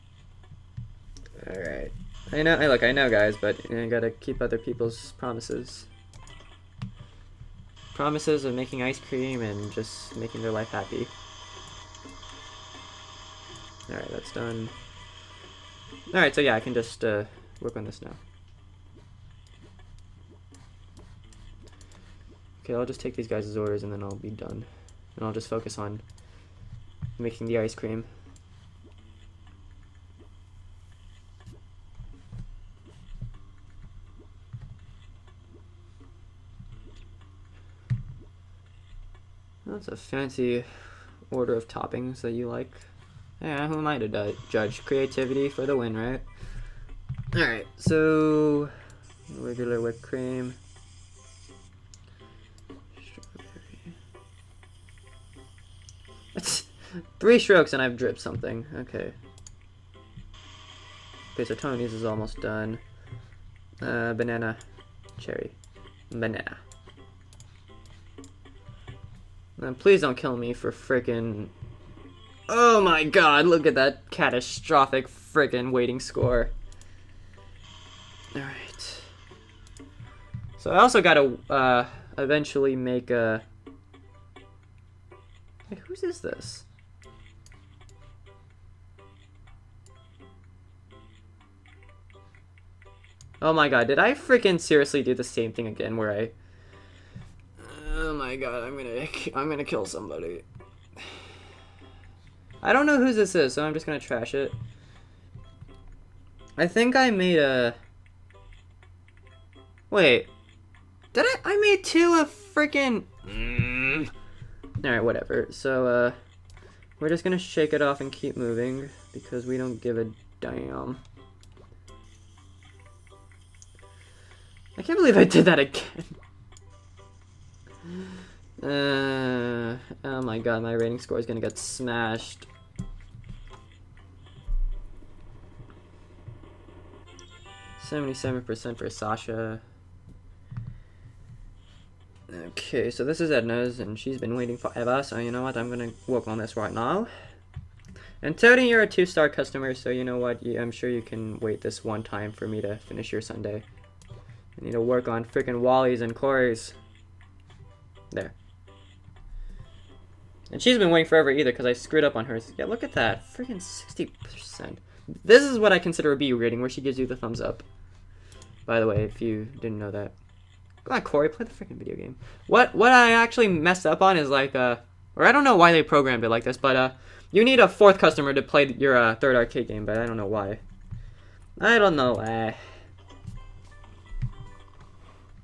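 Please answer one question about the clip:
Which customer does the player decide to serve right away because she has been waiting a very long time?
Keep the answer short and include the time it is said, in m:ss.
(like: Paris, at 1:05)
Edna, at 2:23.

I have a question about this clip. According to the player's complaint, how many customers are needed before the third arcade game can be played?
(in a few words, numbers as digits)
4.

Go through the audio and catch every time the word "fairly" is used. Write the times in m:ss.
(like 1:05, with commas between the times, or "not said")
not said.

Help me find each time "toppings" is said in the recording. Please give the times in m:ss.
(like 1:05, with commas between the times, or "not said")
0:41.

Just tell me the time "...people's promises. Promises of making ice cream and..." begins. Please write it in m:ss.
0:04.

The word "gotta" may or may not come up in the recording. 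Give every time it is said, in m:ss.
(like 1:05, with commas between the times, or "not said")
0:03, 1:20.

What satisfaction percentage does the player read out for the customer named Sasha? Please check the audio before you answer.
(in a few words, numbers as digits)
77%.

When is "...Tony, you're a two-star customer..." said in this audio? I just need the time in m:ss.
2:28.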